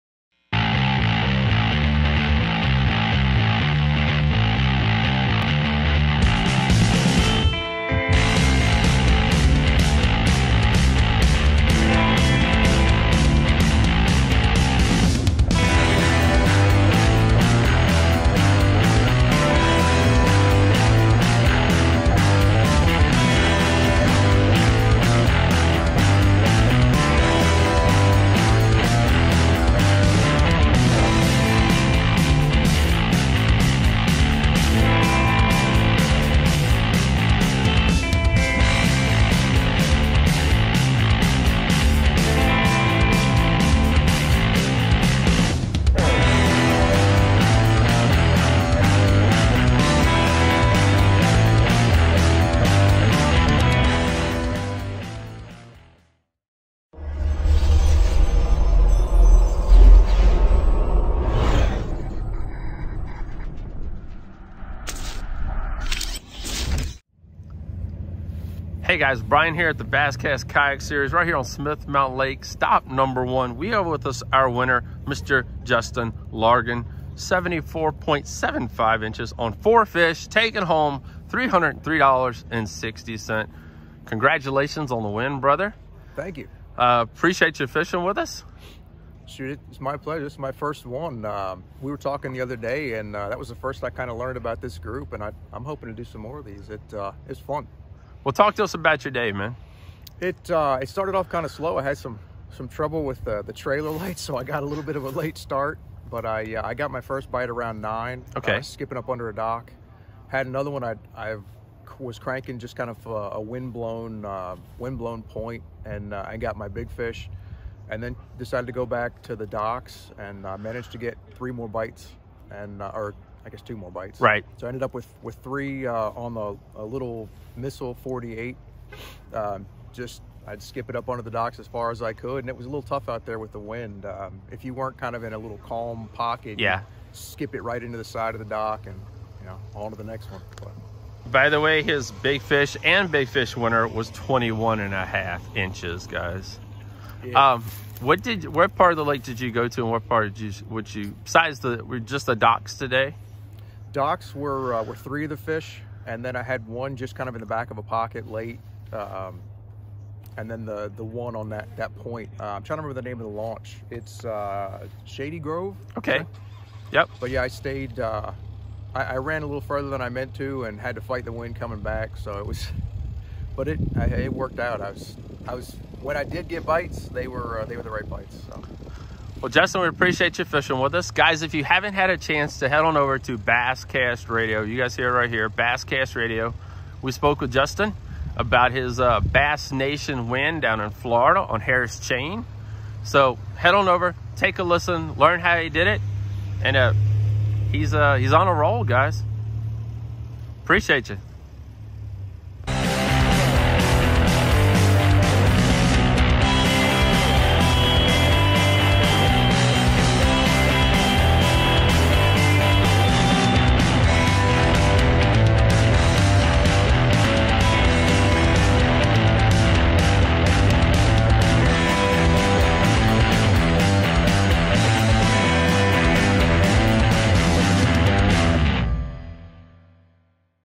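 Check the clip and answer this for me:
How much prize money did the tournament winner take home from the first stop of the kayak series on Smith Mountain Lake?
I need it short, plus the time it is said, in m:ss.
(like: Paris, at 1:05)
$303.60, at 1:21.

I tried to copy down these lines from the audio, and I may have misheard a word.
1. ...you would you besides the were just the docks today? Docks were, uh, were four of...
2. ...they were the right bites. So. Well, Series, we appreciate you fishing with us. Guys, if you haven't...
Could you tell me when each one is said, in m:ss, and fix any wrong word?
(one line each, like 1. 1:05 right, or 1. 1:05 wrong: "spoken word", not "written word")
1. 2:30 wrong: "three", not "four"
2. 2:57 wrong: "Justin", not "Series".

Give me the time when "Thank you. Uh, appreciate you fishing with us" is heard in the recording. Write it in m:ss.
1:26.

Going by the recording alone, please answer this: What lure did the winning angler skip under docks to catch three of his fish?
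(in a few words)
Missile 48.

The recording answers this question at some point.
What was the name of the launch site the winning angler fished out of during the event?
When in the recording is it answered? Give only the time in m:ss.
2:45.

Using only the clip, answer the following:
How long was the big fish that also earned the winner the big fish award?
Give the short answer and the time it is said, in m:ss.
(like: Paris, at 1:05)
21 and a half inches, at 2:24.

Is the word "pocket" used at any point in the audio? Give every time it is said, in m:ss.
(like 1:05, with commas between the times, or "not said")
2:16, 2:37.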